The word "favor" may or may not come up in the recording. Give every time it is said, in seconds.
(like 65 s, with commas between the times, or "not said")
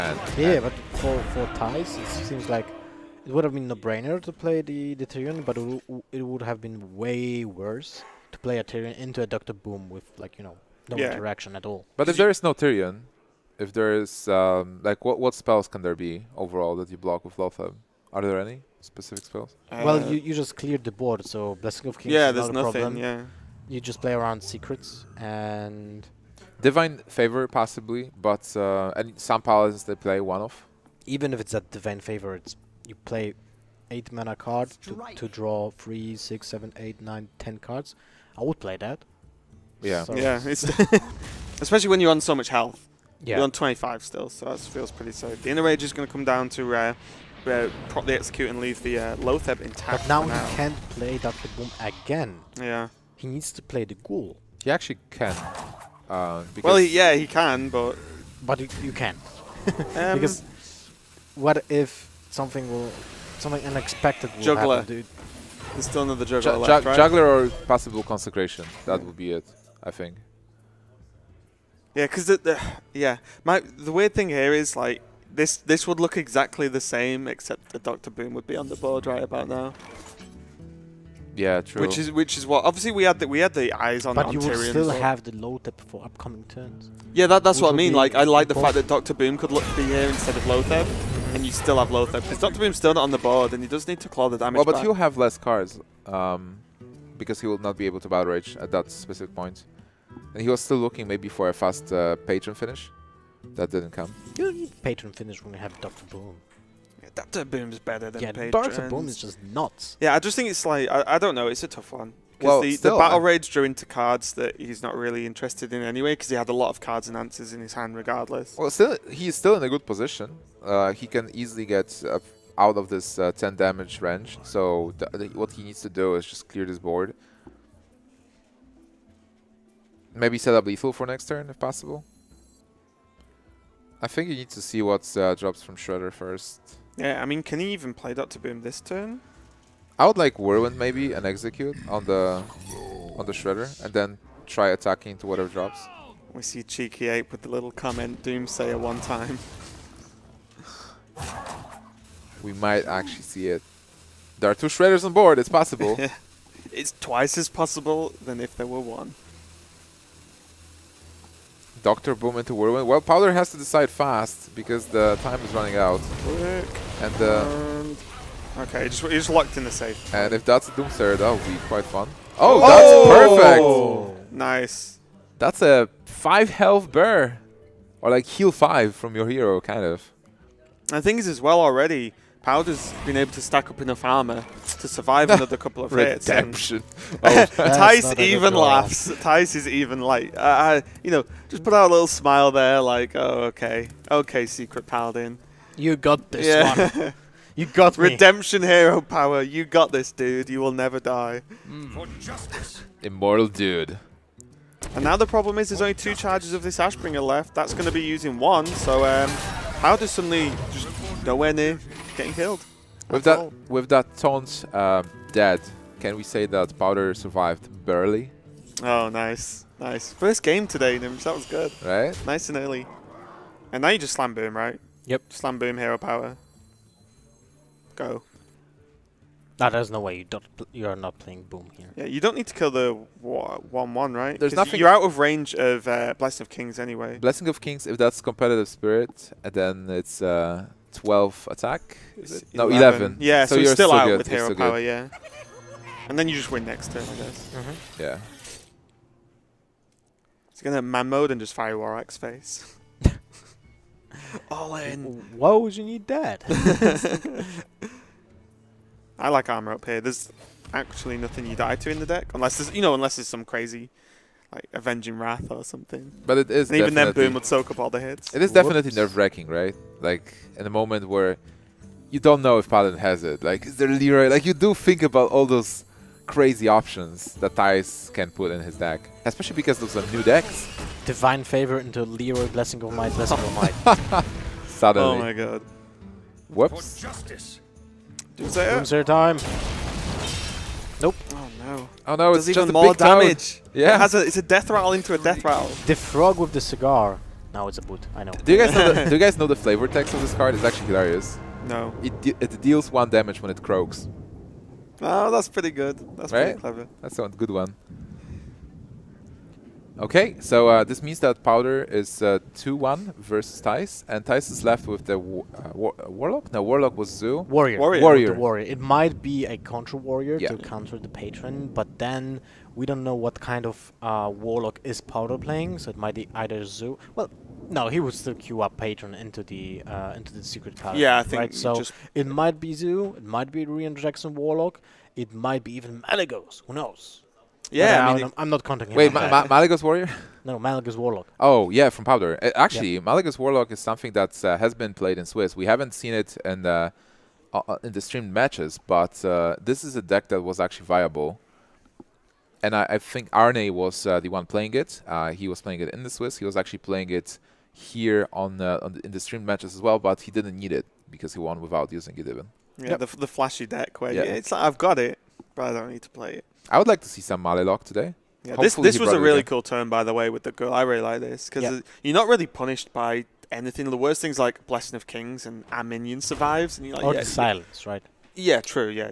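27 s, 31 s, 281 s.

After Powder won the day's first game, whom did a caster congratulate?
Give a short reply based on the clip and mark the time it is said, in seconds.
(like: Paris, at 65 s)
Gnimsh, at 220 s.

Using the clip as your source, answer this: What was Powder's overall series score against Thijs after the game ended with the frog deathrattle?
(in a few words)
2-1.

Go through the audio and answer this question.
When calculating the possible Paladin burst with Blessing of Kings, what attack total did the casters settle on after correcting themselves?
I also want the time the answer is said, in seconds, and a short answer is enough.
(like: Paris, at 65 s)
11, at 242 s.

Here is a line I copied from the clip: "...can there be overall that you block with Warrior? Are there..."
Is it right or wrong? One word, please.
wrong.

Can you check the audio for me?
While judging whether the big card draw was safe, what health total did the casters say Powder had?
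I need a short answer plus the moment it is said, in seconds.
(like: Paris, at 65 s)
25, at 43 s.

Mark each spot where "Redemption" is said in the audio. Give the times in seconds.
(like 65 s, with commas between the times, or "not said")
186 s, 198 s.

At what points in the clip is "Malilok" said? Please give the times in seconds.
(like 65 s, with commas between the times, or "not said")
367 s.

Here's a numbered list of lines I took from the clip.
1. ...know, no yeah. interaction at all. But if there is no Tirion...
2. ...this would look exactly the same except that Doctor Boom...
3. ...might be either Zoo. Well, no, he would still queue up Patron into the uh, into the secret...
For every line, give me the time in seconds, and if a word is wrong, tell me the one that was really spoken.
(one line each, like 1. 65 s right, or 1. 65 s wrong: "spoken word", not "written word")
1. 10 s right
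2. 75 s right
3. 325 s right.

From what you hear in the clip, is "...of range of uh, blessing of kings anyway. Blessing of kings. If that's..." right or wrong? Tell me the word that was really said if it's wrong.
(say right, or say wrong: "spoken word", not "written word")
right.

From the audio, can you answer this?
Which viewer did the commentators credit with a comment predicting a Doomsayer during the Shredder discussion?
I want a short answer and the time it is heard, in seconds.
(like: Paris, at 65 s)
Cheeky Ape, at 146 s.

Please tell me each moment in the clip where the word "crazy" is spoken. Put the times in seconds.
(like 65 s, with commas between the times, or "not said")
263 s, 276 s.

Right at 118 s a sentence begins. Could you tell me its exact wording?
Well, still, he's still in a good position.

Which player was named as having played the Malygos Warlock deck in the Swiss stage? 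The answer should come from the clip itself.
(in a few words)
Arne.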